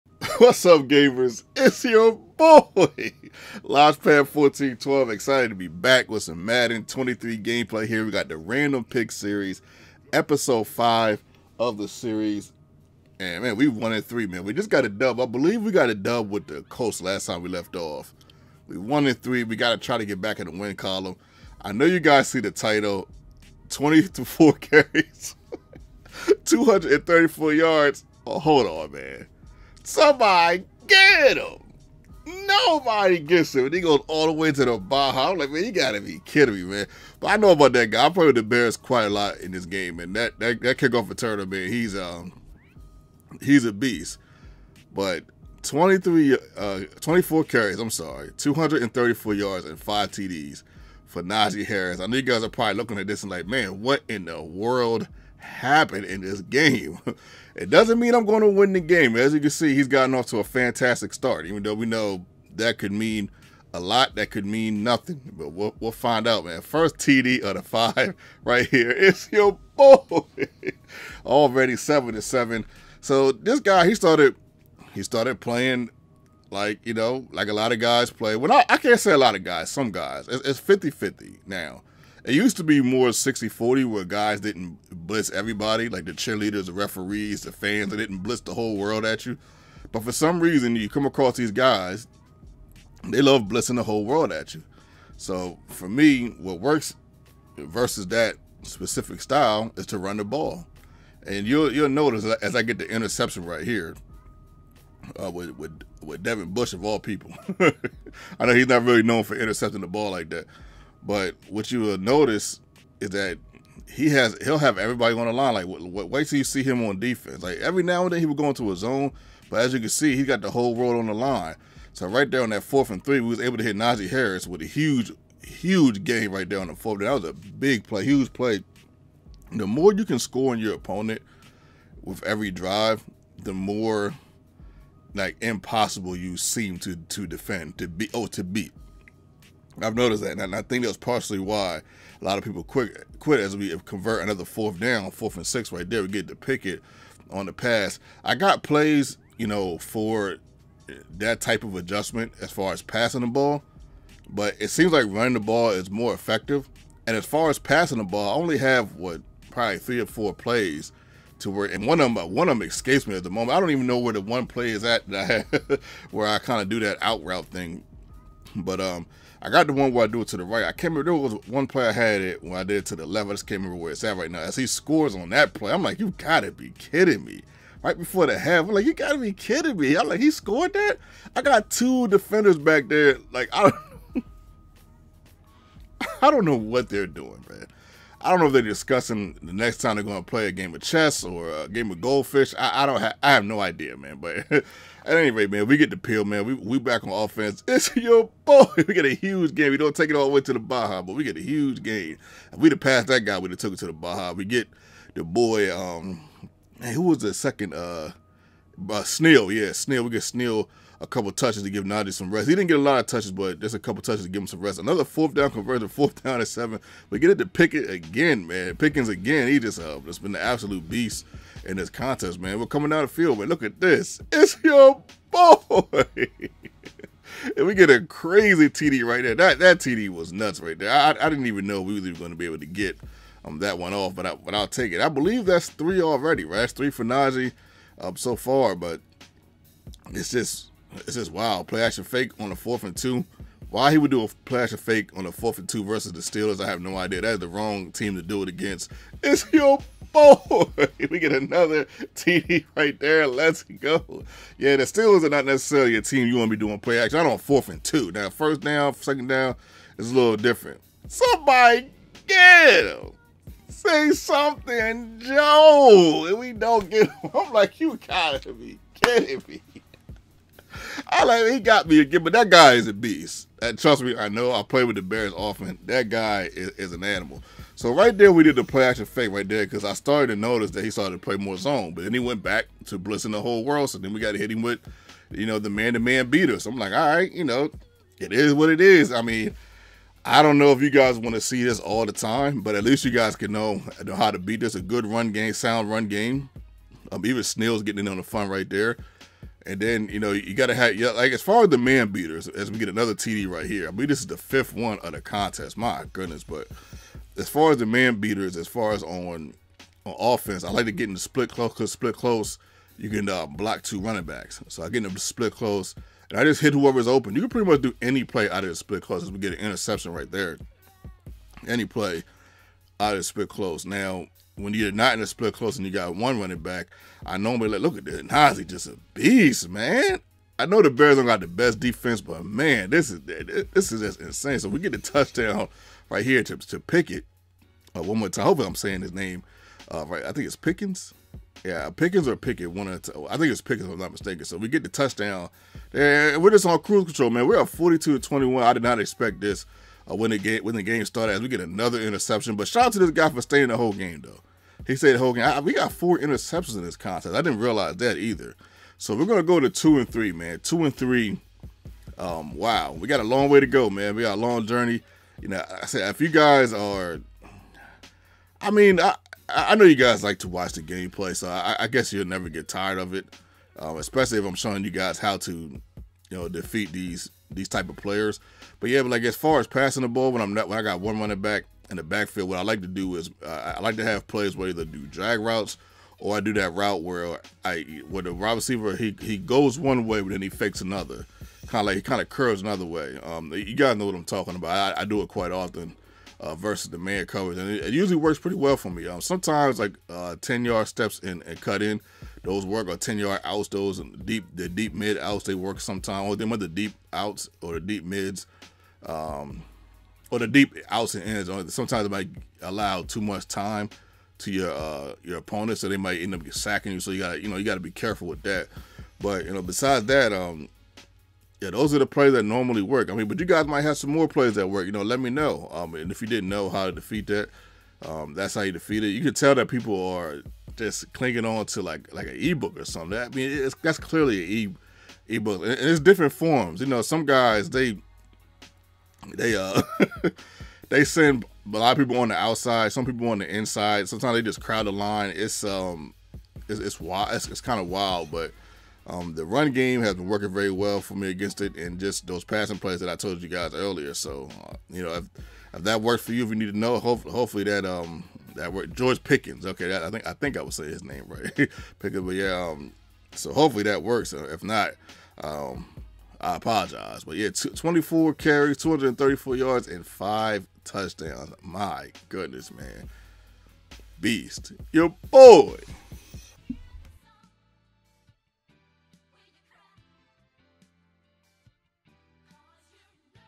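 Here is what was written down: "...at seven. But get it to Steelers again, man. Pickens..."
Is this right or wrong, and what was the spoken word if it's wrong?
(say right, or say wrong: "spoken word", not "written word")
wrong: "Pickett", not "Steelers".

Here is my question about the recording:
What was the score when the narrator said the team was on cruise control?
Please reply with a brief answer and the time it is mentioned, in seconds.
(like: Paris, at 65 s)
42 to 21, at 347 s.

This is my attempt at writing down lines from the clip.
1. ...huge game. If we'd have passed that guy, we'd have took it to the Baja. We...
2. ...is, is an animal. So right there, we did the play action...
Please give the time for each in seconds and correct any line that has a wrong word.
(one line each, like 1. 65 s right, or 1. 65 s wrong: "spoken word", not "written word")
1. 201 s right
2. 276 s right.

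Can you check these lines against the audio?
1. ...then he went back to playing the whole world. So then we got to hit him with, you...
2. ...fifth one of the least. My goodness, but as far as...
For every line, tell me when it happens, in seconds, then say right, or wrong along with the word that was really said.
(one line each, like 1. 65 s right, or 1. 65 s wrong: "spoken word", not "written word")
1. 282 s wrong: "blitzing", not "playing"
2. 304 s wrong: "contest", not "least".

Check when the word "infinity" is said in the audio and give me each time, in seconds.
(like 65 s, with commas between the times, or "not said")
not said.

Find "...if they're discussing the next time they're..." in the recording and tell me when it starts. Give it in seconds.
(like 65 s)
188 s.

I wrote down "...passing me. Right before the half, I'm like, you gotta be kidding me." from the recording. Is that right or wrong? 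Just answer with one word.
wrong.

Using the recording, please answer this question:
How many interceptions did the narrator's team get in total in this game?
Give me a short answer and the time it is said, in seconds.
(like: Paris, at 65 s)
4, at 355 s.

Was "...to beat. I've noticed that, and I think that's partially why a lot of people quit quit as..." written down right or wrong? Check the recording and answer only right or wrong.
right.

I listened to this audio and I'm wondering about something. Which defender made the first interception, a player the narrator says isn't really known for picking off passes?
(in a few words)
Devin Bush.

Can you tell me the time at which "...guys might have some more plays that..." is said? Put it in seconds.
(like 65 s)
423 s.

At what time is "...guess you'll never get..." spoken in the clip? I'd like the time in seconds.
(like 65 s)
371 s.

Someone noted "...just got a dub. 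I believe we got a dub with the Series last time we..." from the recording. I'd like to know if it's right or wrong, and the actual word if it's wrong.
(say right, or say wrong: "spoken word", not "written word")
wrong: "Colts", not "Series".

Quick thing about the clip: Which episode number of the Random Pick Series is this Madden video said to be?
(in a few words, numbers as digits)
5.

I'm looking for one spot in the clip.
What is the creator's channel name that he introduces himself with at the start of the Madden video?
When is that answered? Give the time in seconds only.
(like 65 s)
3 s.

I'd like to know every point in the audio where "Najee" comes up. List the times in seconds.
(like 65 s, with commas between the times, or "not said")
51 s, 123 s, 211 s, 237 s, 328 s.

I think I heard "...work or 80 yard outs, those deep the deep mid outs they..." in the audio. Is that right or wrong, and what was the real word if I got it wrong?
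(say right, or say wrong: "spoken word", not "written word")
wrong: "10", not "80".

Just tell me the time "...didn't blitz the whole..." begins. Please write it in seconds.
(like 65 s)
87 s.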